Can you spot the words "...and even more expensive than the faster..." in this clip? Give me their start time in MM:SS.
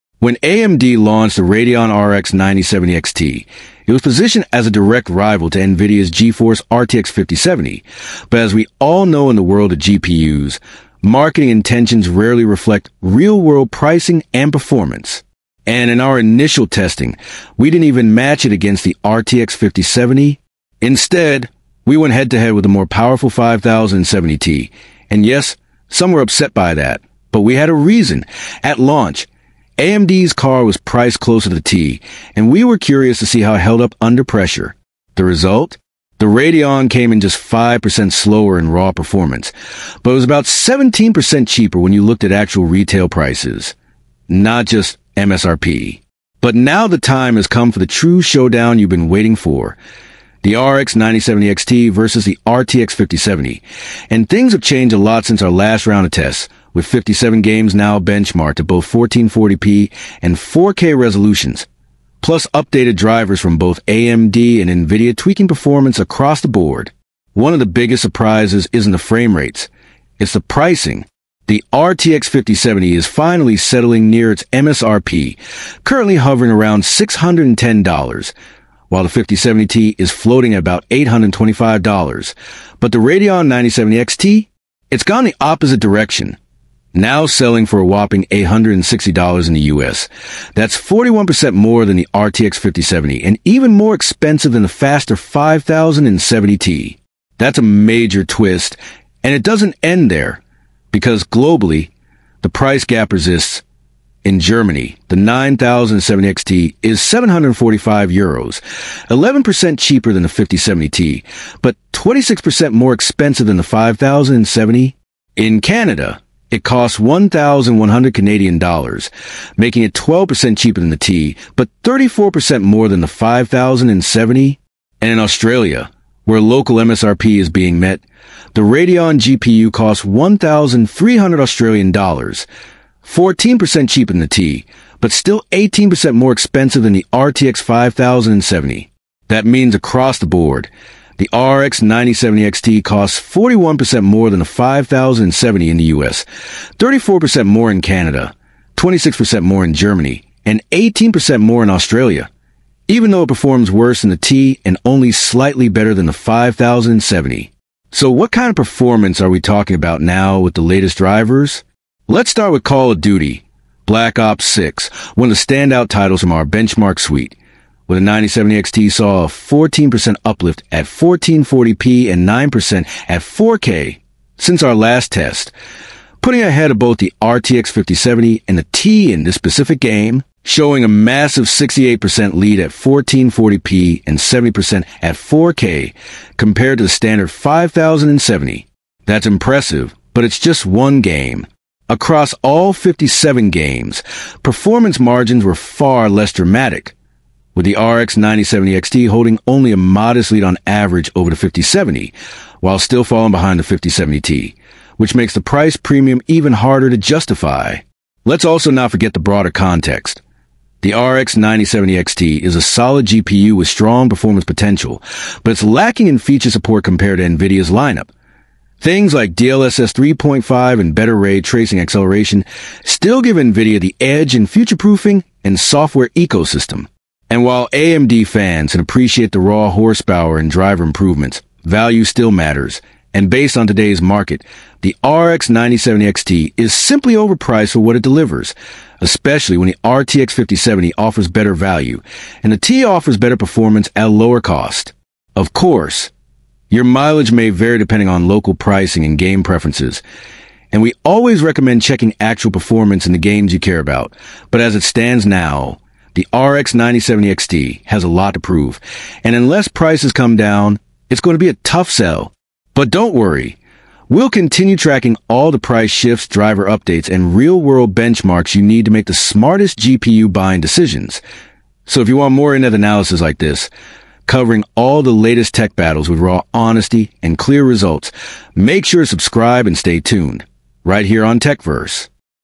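01:33.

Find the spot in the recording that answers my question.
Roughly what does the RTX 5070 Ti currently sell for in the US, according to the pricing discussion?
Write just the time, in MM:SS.
01:20.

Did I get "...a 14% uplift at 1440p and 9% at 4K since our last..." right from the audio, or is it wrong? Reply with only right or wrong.
right.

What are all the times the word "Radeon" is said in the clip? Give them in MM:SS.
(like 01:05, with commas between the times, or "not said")
00:01, 00:36, 01:22, 02:08.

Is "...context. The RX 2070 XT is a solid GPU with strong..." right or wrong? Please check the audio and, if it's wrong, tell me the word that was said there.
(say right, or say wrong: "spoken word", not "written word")
wrong: "9070", not "2070".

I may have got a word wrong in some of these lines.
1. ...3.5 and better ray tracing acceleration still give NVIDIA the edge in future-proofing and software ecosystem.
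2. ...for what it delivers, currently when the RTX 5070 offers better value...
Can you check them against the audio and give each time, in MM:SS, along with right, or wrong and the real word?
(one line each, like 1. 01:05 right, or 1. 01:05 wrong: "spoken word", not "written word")
1. 03:39 right
2. 03:57 wrong: "especially", not "currently".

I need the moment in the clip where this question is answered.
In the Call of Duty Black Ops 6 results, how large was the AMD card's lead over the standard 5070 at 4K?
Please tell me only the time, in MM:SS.
03:04.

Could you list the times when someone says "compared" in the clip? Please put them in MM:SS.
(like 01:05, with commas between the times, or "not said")
03:06, 03:36.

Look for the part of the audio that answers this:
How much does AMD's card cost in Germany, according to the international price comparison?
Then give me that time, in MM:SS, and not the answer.
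01:47.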